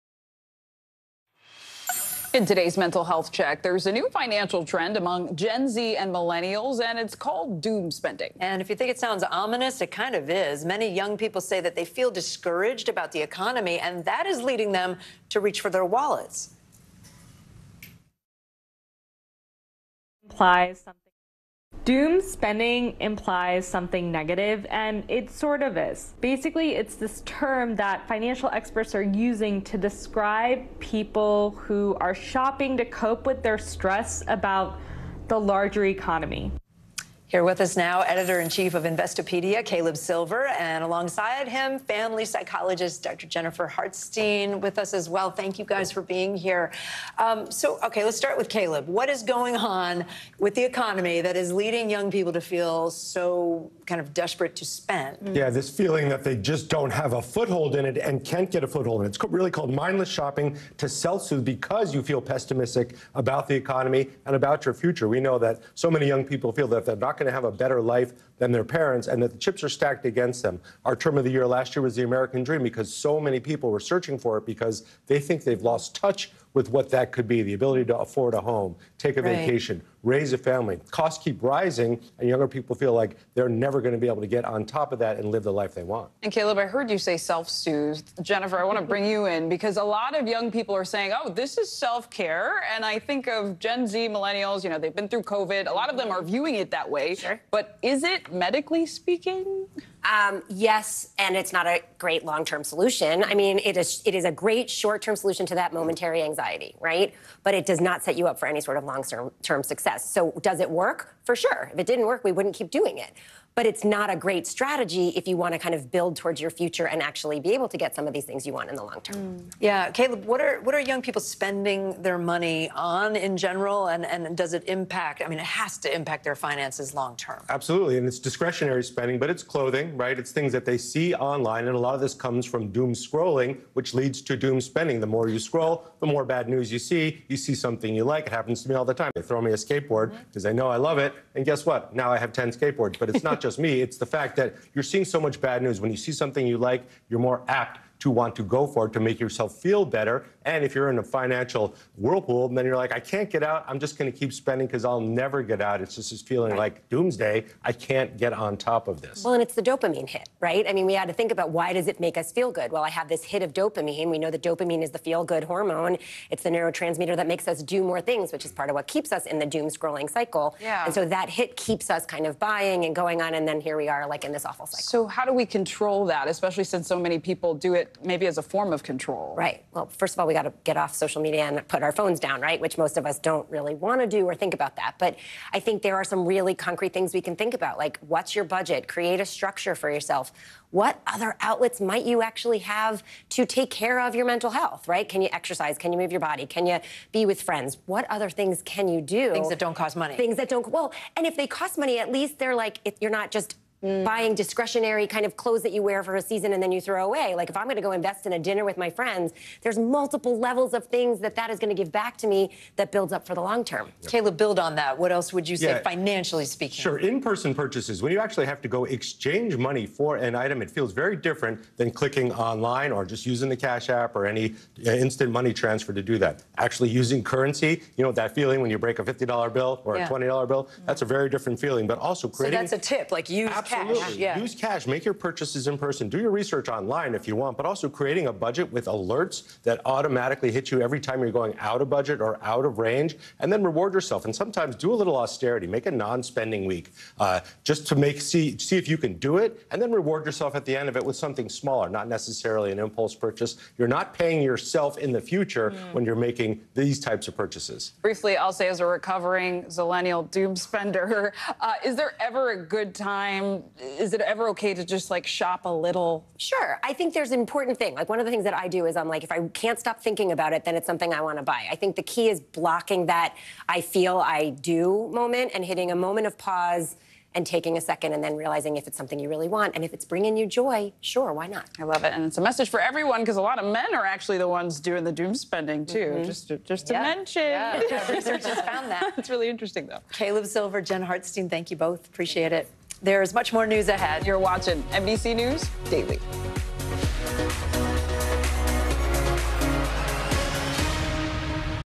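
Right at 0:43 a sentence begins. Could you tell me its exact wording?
Jennifer Hartstein with us as well.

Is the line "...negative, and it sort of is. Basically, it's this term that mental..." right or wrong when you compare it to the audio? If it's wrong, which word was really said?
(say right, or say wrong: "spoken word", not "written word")
wrong: "financial", not "mental".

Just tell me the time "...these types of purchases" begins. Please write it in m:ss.
4:16.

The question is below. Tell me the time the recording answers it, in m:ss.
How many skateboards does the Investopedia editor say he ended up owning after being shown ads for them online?
2:22.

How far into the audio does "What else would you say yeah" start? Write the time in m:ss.
3:34.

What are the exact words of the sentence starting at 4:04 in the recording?
And sometimes do a little austerity.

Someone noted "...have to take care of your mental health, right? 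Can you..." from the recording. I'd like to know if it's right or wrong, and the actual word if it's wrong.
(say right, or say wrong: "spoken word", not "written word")
right.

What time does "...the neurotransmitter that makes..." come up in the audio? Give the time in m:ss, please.
2:46.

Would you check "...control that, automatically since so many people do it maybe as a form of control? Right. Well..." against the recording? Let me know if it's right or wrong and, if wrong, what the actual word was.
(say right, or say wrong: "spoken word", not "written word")
wrong: "especially", not "automatically".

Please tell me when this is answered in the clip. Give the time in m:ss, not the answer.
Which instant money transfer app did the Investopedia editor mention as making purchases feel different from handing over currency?
3:43.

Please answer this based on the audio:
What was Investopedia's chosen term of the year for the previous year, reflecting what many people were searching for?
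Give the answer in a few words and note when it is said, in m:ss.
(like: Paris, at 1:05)
The American dream, at 1:11.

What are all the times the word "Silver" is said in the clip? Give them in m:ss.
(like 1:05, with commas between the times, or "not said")
0:39, 4:50.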